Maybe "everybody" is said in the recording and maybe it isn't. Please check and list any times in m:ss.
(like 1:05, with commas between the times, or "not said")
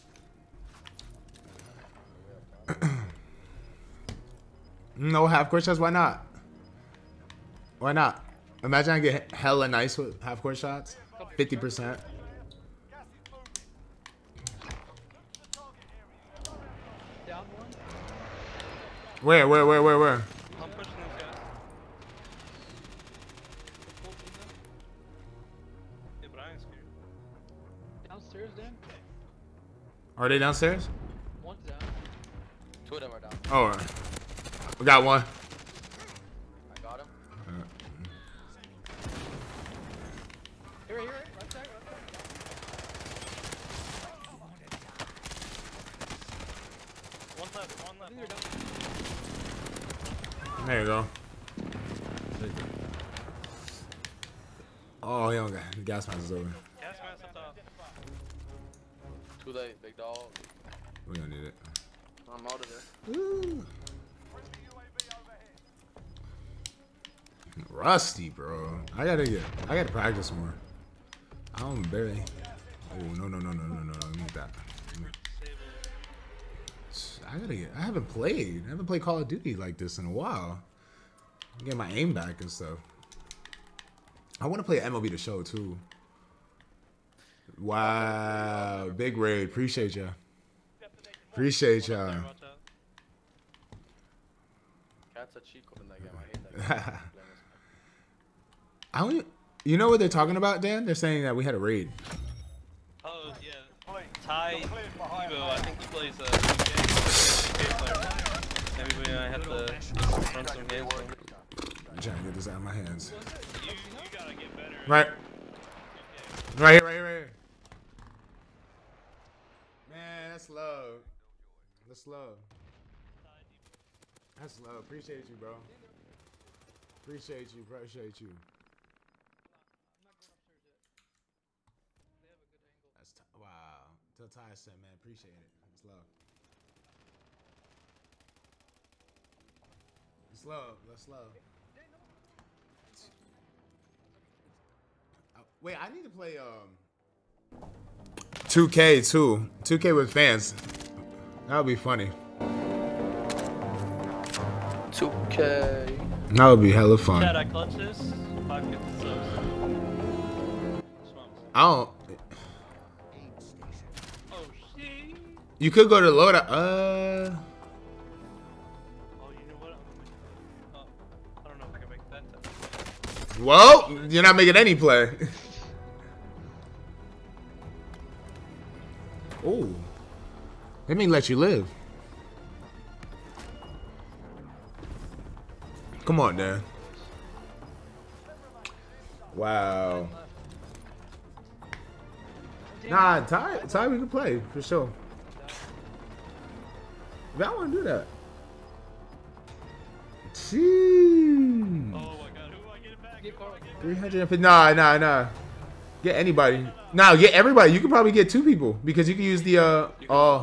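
1:48, 3:27.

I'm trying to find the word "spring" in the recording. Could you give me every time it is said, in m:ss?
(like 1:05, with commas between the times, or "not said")
not said.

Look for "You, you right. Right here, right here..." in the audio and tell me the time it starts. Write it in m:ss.
1:53.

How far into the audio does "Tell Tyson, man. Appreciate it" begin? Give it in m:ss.
2:14.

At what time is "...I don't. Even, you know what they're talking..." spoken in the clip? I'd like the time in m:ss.
1:38.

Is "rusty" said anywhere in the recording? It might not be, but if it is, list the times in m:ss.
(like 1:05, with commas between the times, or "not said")
1:07.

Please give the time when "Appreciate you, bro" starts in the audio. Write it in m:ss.
2:04.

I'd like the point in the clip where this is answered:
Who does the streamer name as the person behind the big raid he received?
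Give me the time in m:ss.
1:44.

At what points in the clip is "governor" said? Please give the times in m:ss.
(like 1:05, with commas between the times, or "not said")
not said.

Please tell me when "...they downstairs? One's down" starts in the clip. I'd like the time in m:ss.
0:30.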